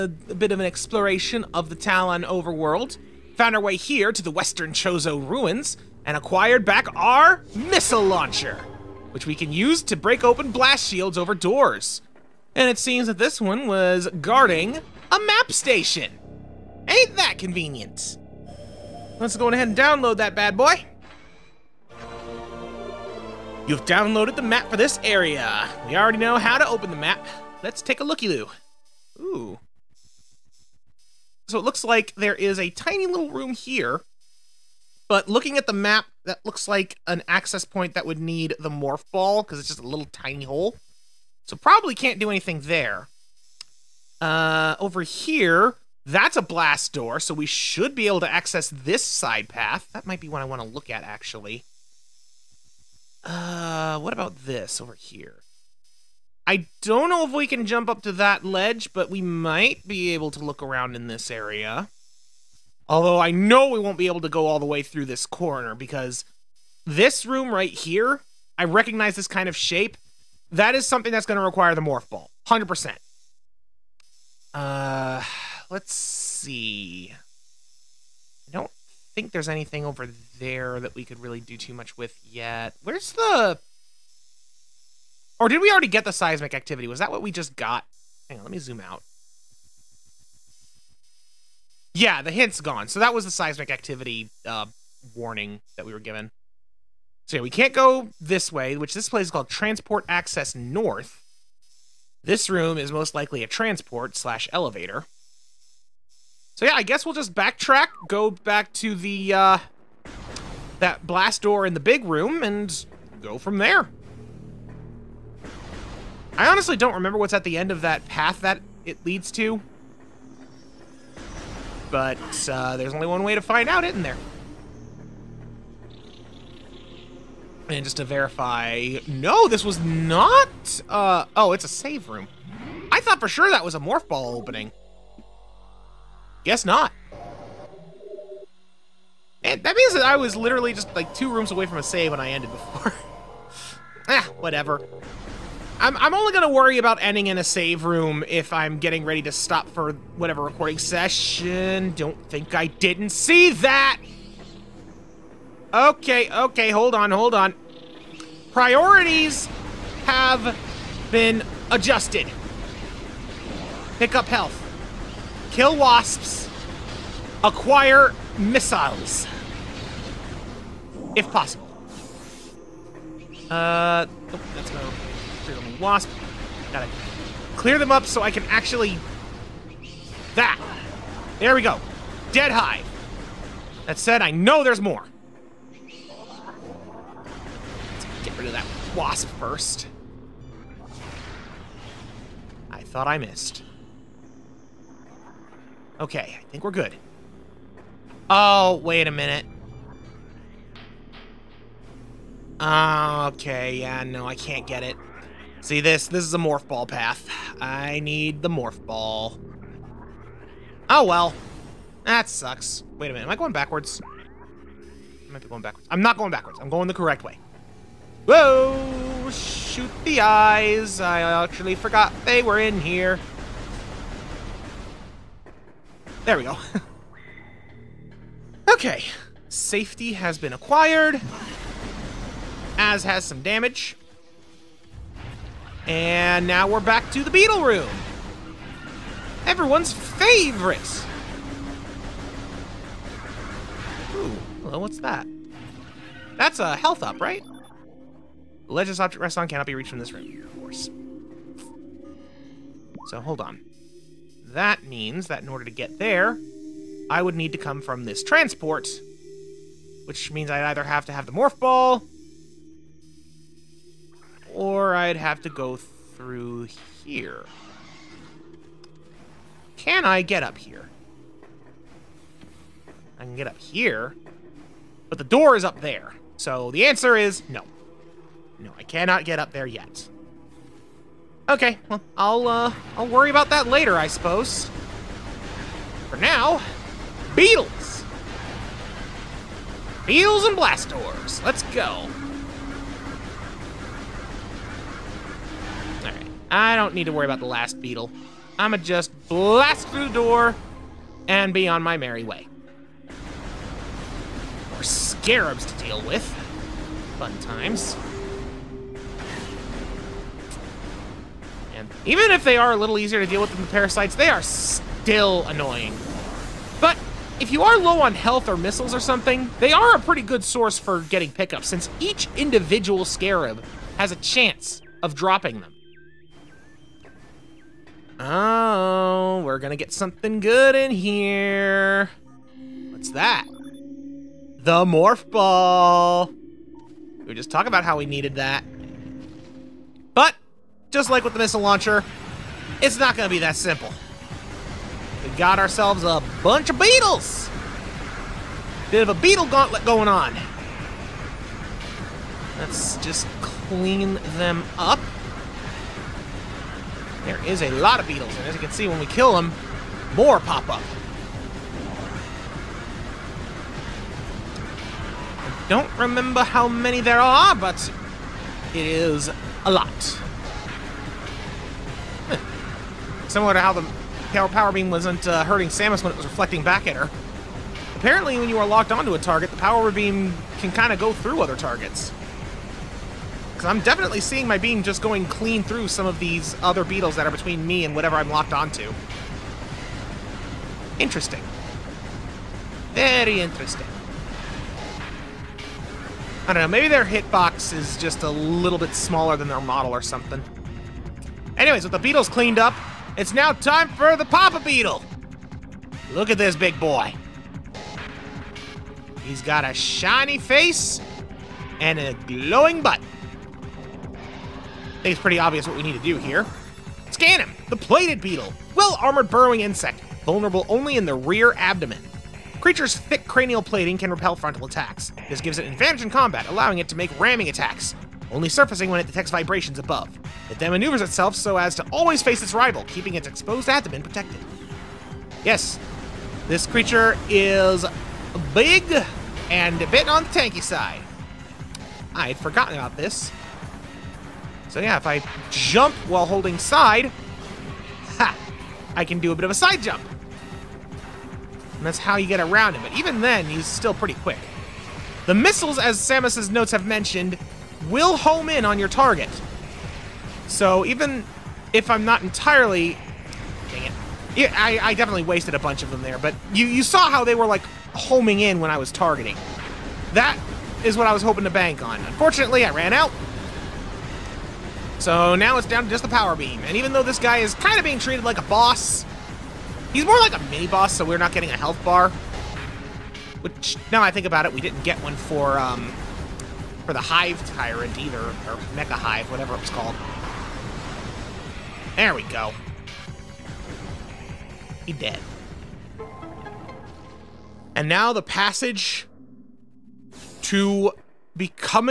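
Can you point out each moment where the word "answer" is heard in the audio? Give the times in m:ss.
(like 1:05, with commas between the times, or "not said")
4:36.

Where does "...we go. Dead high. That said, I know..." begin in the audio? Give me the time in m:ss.
3:01.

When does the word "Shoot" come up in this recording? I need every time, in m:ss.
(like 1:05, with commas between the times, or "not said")
3:39.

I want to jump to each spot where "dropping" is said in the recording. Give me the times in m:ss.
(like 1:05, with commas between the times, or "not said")
5:25.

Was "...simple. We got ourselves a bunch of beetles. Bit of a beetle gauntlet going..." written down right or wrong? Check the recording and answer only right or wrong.
right.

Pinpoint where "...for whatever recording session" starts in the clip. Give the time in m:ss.
2:29.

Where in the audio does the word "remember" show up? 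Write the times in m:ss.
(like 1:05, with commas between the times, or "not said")
1:56, 6:05.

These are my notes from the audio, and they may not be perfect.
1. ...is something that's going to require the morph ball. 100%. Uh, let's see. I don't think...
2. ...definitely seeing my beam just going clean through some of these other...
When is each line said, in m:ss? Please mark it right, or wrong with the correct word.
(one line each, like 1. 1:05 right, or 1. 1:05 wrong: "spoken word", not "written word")
1. 1:10 right
2. 6:23 right.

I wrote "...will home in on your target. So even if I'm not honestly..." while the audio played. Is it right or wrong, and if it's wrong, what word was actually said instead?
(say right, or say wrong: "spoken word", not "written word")
wrong: "entirely", not "honestly".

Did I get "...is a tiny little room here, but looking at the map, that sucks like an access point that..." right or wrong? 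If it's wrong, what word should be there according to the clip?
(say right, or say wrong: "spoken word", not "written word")
wrong: "looks", not "sucks".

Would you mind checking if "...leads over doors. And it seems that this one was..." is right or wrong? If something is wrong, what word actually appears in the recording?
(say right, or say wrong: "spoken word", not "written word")
wrong: "shields", not "leads".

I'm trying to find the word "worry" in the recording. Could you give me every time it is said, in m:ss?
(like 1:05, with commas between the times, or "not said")
2:26, 4:43, 4:57.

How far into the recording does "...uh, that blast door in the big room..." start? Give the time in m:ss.
1:49.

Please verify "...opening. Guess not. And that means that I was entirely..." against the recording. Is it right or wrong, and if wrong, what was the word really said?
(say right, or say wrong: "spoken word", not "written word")
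wrong: "literally", not "entirely".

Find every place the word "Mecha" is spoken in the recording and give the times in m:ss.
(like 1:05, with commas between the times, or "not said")
8:08.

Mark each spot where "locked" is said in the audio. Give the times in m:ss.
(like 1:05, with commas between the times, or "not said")
6:18, 6:28.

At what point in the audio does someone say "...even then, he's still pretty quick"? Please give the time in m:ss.
7:32.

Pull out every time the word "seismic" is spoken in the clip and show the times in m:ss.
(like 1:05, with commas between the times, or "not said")
1:26, 1:33.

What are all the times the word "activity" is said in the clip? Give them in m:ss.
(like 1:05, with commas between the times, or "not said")
1:26, 1:33.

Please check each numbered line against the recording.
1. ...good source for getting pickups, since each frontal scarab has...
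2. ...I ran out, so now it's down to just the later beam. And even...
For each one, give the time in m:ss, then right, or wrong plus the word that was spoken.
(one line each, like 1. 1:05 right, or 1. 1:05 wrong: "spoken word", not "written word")
1. 5:20 wrong: "individual", not "frontal"
2. 7:52 wrong: "power", not "later".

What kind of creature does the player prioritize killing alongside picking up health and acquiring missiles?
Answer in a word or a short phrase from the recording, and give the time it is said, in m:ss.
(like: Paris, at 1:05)
wasps, at 2:45.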